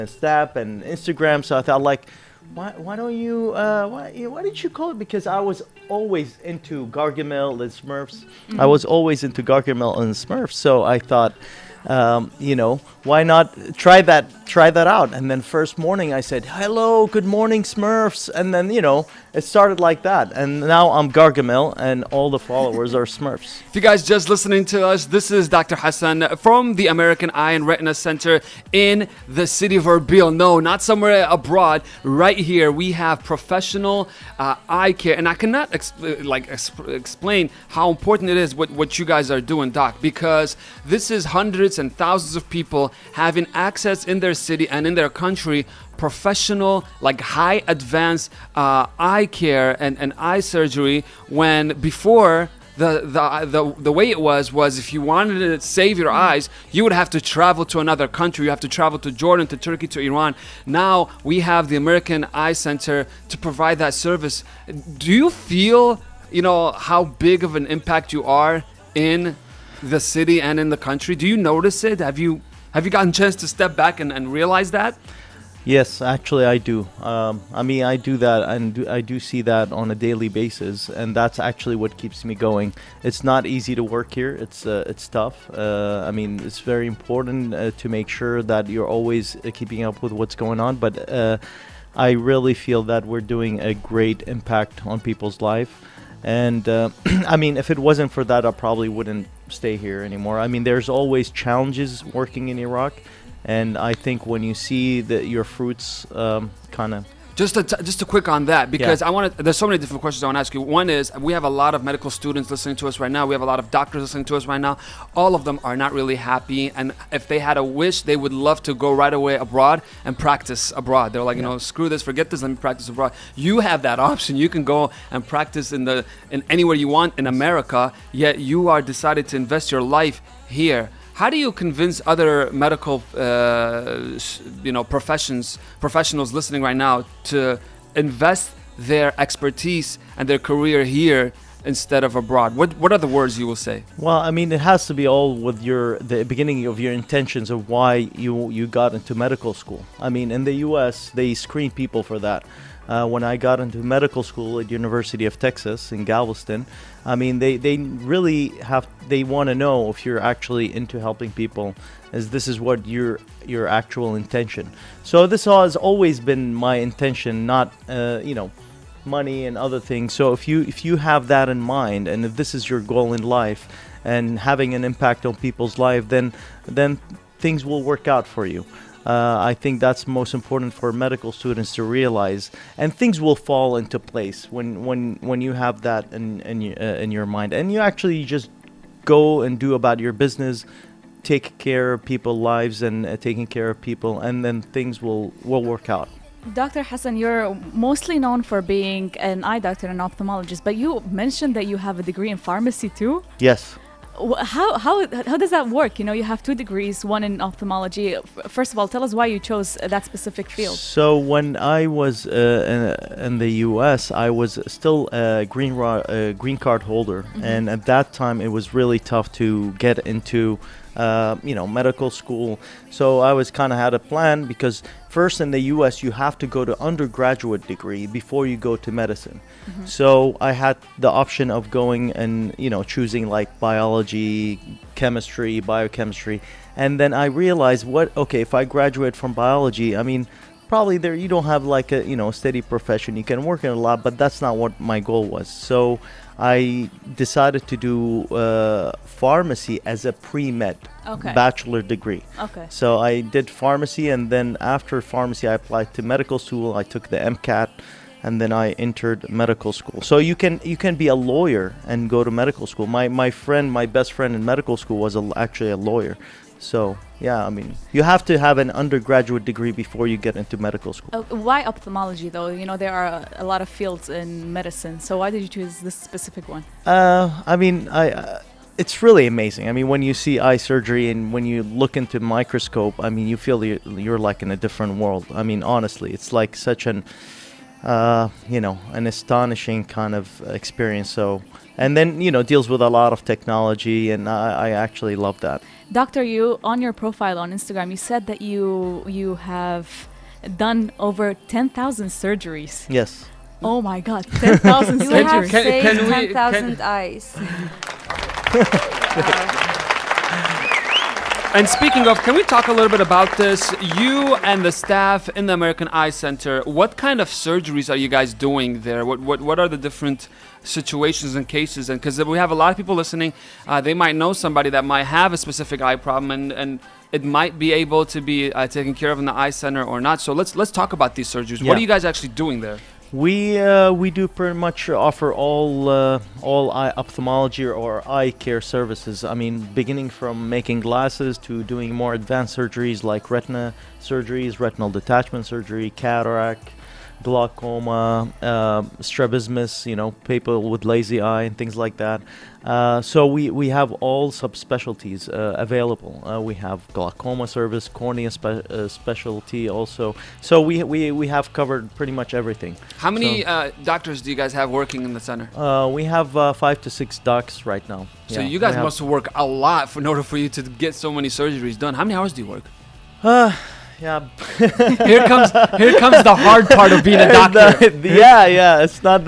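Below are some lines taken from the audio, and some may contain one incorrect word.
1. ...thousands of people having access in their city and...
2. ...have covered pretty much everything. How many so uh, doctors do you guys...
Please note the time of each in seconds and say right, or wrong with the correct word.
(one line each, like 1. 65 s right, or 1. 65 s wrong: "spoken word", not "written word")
1. 41 s right
2. 361 s right.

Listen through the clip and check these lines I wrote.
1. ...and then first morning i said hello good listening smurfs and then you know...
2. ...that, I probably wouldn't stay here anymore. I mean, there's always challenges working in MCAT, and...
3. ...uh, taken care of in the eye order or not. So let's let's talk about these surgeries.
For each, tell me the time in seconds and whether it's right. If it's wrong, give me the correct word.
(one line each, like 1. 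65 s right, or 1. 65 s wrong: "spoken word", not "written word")
1. 15 s wrong: "morning", not "listening"
2. 98 s wrong: "Iraq", not "MCAT"
3. 328 s wrong: "center", not "order".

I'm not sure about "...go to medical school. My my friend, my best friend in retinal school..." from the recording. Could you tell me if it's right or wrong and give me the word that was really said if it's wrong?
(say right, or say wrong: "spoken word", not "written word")
wrong: "medical", not "retinal".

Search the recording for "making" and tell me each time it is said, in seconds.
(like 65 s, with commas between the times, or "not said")
340 s.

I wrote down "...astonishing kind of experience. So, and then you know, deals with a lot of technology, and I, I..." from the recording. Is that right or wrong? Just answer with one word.
right.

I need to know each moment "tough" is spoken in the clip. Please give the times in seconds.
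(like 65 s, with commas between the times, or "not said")
85 s, 218 s.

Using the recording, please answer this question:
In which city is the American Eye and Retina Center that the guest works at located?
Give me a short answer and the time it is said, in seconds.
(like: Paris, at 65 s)
Erbil, at 29 s.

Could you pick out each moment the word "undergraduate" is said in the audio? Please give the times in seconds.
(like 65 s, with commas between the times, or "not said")
226 s, 268 s.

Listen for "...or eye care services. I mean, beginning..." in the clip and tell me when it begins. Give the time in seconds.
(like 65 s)
337 s.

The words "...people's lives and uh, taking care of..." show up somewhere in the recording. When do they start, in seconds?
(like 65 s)
192 s.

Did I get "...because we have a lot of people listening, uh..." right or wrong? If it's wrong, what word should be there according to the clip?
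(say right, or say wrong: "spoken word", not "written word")
right.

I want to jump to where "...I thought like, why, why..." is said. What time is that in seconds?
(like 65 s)
1 s.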